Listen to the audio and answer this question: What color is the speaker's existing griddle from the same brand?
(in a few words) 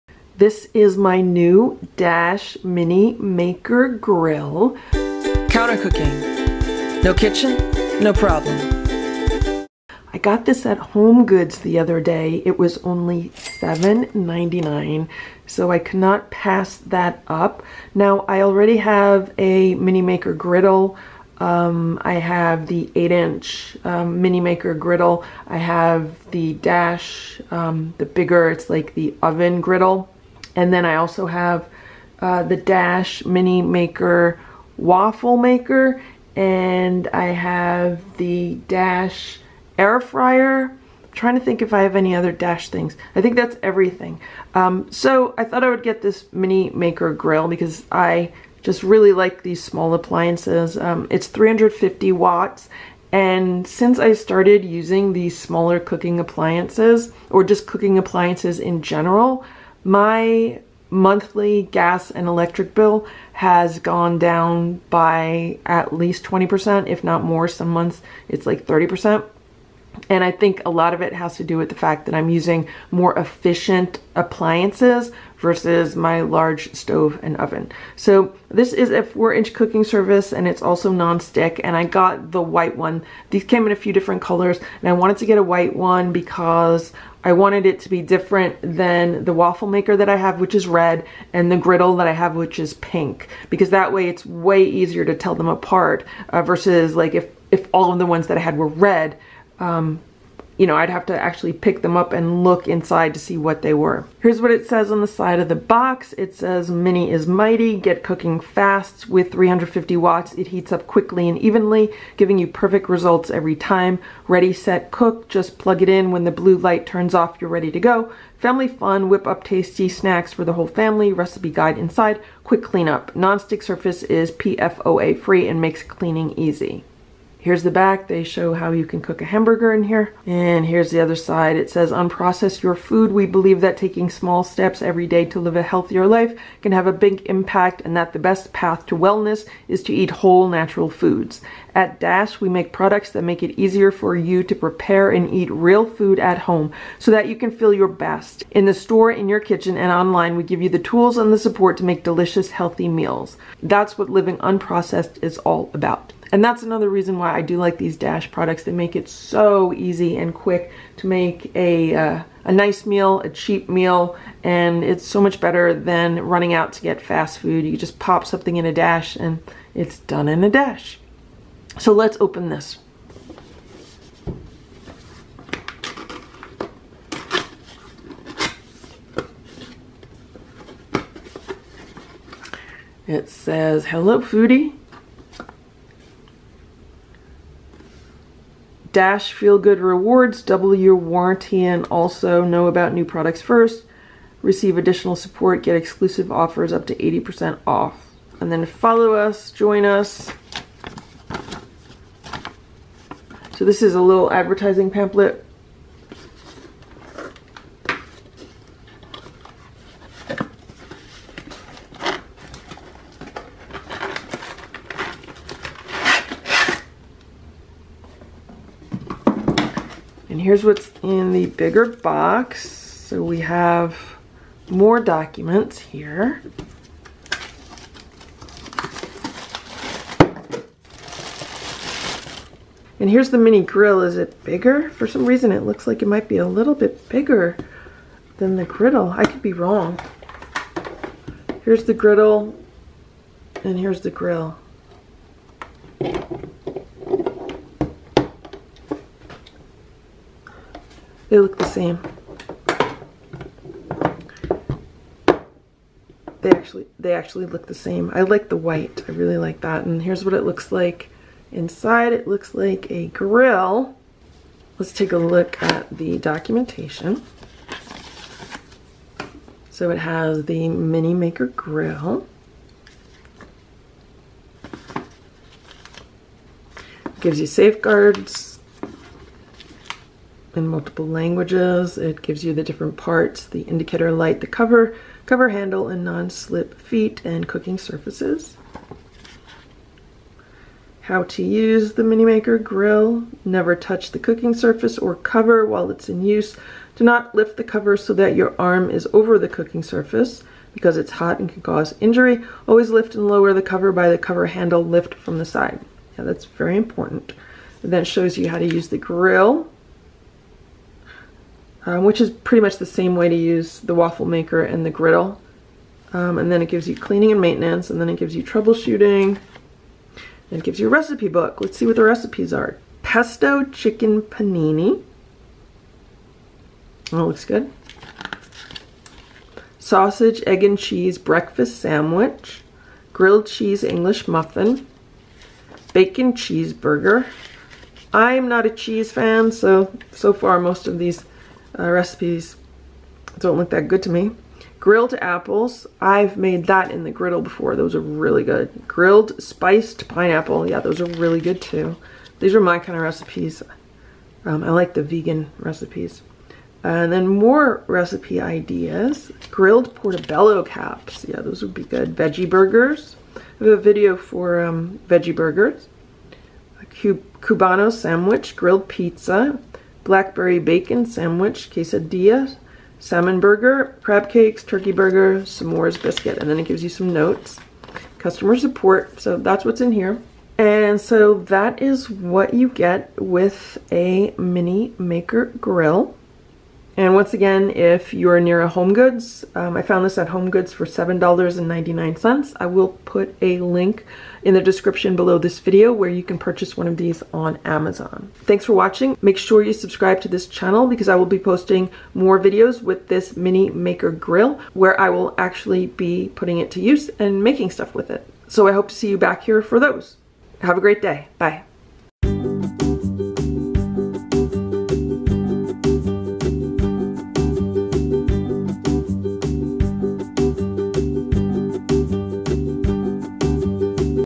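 Pink.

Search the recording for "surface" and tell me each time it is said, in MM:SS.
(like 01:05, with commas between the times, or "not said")
02:03, 04:47, 04:54, 04:59.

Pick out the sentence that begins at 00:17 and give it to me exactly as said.
Now, I already have a Mini Maker griddle.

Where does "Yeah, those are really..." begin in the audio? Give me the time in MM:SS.
05:50.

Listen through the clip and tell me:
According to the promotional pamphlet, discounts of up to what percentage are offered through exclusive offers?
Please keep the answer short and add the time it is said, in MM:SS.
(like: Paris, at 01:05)
80%, at 03:16.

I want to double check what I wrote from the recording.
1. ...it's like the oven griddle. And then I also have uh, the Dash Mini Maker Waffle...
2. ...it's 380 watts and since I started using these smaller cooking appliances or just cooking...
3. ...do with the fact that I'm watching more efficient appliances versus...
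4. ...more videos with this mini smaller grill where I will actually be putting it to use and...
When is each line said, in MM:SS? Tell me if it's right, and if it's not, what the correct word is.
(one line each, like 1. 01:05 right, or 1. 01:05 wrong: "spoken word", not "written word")
1. 00:28 right
2. 00:51 wrong: "350", not "380"
3. 01:11 wrong: "using", not "watching"
4. 06:42 wrong: "maker", not "smaller".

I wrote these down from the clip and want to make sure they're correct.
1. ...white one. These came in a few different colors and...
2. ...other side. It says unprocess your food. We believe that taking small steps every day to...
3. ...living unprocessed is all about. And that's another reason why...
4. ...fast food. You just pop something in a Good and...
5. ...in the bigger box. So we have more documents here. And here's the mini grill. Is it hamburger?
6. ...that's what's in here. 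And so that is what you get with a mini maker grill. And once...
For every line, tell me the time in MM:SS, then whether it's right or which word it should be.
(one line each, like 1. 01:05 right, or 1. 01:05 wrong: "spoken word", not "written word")
1. 01:22 right
2. 02:10 right
3. 02:34 right
4. 02:47 wrong: "Dash", not "Good"
5. 03:41 wrong: "bigger", not "hamburger"
6. 06:19 right.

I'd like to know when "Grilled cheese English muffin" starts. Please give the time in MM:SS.
05:33.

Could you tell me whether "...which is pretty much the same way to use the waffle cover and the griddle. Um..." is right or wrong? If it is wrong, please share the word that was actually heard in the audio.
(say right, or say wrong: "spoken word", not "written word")
wrong: "maker", not "cover".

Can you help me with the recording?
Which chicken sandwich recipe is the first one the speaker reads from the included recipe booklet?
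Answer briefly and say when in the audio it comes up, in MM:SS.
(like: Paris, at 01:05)
Pesto chicken panini, at 05:23.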